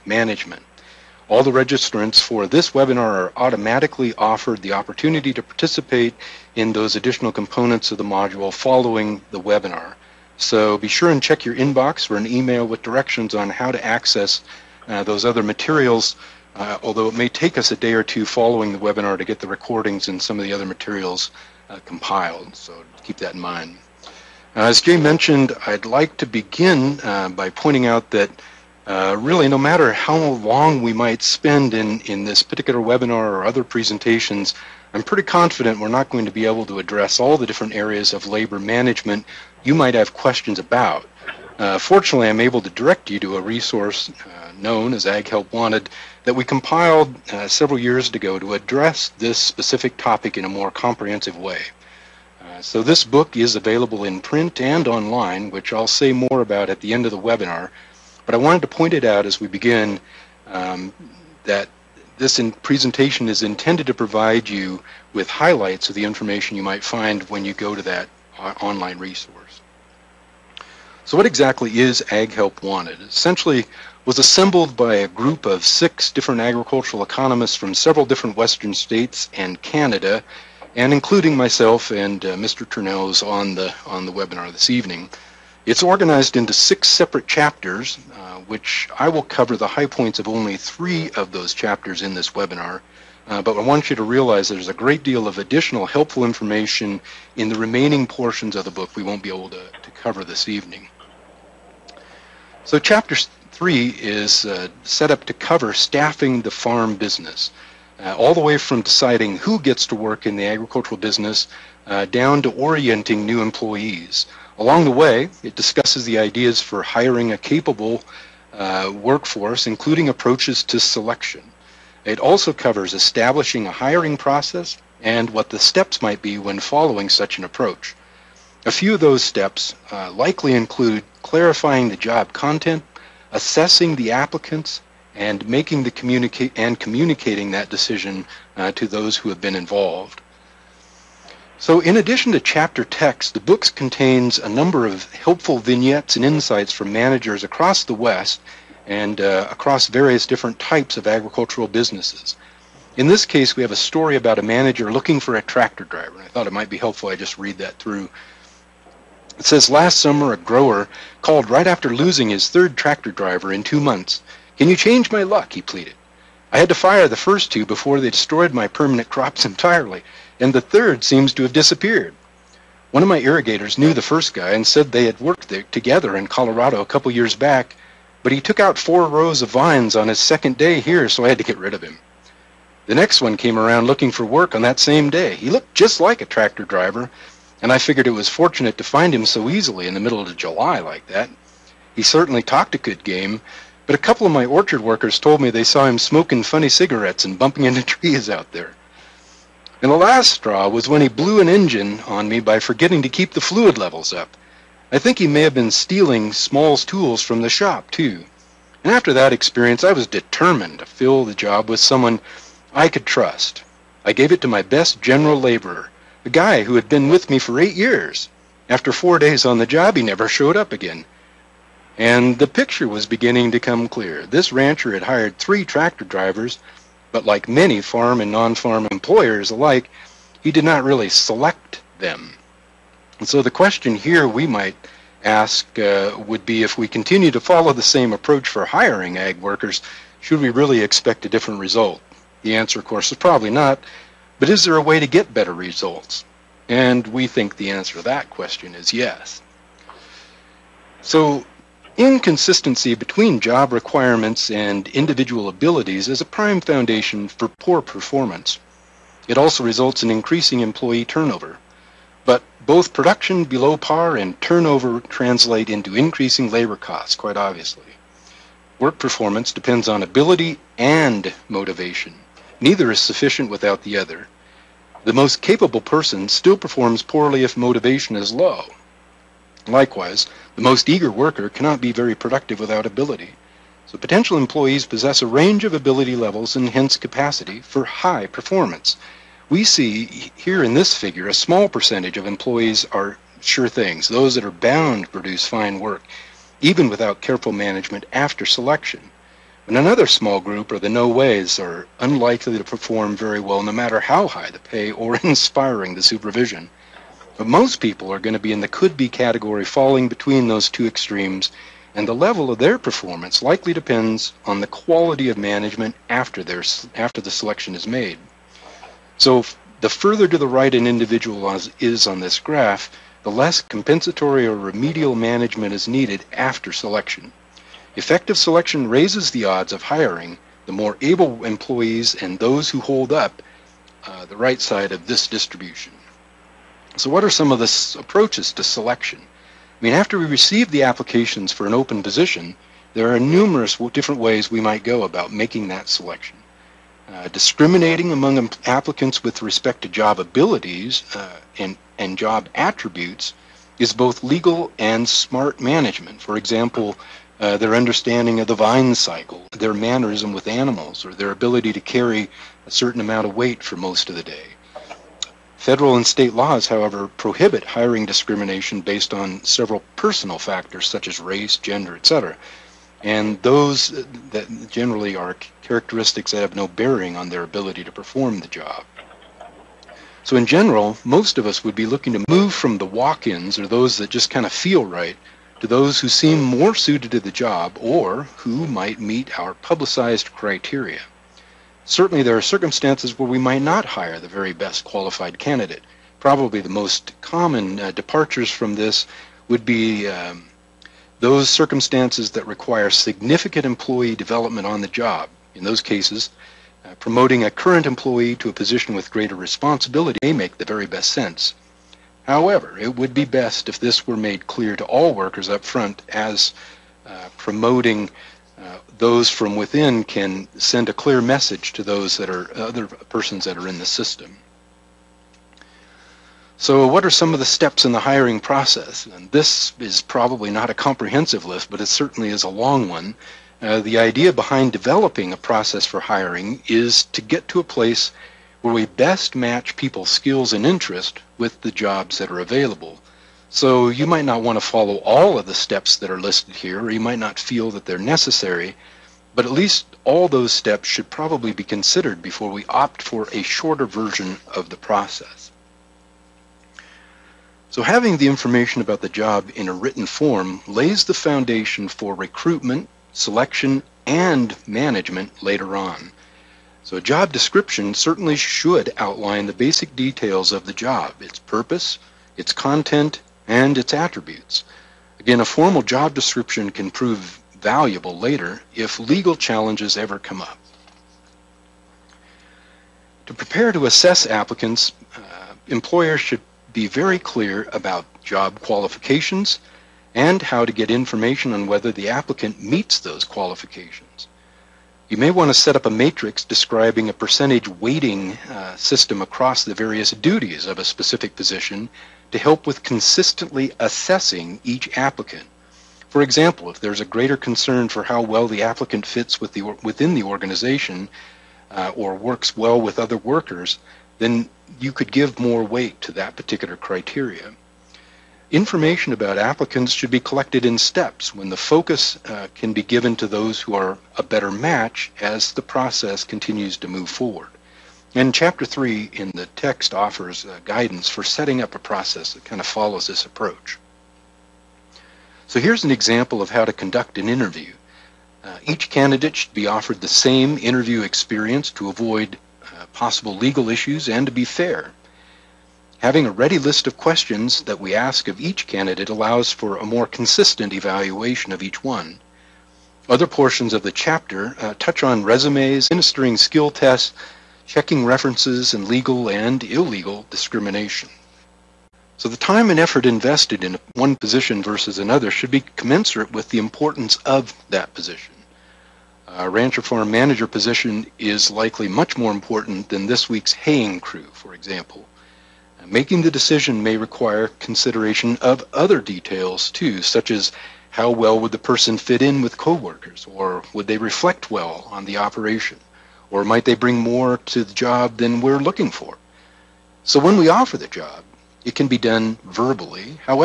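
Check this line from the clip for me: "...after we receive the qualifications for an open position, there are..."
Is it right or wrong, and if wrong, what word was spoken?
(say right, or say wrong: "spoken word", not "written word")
wrong: "applications", not "qualifications".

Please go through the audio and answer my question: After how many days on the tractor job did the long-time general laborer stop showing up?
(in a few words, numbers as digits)
4.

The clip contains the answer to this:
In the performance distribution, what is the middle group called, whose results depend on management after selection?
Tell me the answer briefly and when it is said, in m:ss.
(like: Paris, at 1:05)
could be, at 5:08.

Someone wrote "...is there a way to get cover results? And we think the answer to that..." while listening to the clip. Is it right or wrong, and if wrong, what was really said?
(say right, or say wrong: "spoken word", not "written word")
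wrong: "better", not "cover".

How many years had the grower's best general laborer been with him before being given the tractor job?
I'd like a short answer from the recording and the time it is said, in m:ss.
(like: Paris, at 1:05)
8, at 3:37.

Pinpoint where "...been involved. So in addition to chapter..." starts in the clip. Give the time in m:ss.
2:19.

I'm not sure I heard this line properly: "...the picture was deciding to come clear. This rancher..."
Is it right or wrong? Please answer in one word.
wrong.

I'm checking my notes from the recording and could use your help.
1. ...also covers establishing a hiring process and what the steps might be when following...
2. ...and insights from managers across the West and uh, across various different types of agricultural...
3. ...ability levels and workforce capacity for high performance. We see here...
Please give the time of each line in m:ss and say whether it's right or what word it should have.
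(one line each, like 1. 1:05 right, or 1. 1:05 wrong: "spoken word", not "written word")
1. 2:02 right
2. 2:26 right
3. 4:45 wrong: "hence", not "workforce".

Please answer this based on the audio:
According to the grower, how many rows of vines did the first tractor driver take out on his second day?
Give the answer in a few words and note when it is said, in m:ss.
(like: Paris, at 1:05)
4, at 2:58.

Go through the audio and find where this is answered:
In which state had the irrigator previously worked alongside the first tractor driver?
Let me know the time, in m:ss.
2:56.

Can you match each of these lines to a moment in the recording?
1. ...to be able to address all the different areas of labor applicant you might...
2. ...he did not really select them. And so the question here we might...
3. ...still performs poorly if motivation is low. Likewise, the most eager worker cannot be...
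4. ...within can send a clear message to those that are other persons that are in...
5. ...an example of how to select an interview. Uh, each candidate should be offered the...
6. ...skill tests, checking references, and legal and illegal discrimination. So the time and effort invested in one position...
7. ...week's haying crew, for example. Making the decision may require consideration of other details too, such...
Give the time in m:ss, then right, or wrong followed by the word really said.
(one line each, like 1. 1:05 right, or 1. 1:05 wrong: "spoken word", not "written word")
1. 0:36 wrong: "management", not "applicant"
2. 3:50 right
3. 4:36 right
4. 6:59 right
5. 8:55 wrong: "conduct", not "select"
6. 9:16 right
7. 9:33 right.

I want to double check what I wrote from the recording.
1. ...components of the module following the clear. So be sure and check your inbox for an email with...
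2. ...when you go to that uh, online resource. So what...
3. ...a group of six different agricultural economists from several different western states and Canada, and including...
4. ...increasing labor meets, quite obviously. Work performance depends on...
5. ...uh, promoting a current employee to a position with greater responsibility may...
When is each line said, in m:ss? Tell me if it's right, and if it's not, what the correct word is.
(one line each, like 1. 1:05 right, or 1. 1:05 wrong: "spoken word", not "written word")
1. 0:07 wrong: "webinar", not "clear"
2. 1:07 right
3. 1:14 right
4. 4:25 wrong: "costs", not "meets"
5. 6:46 right.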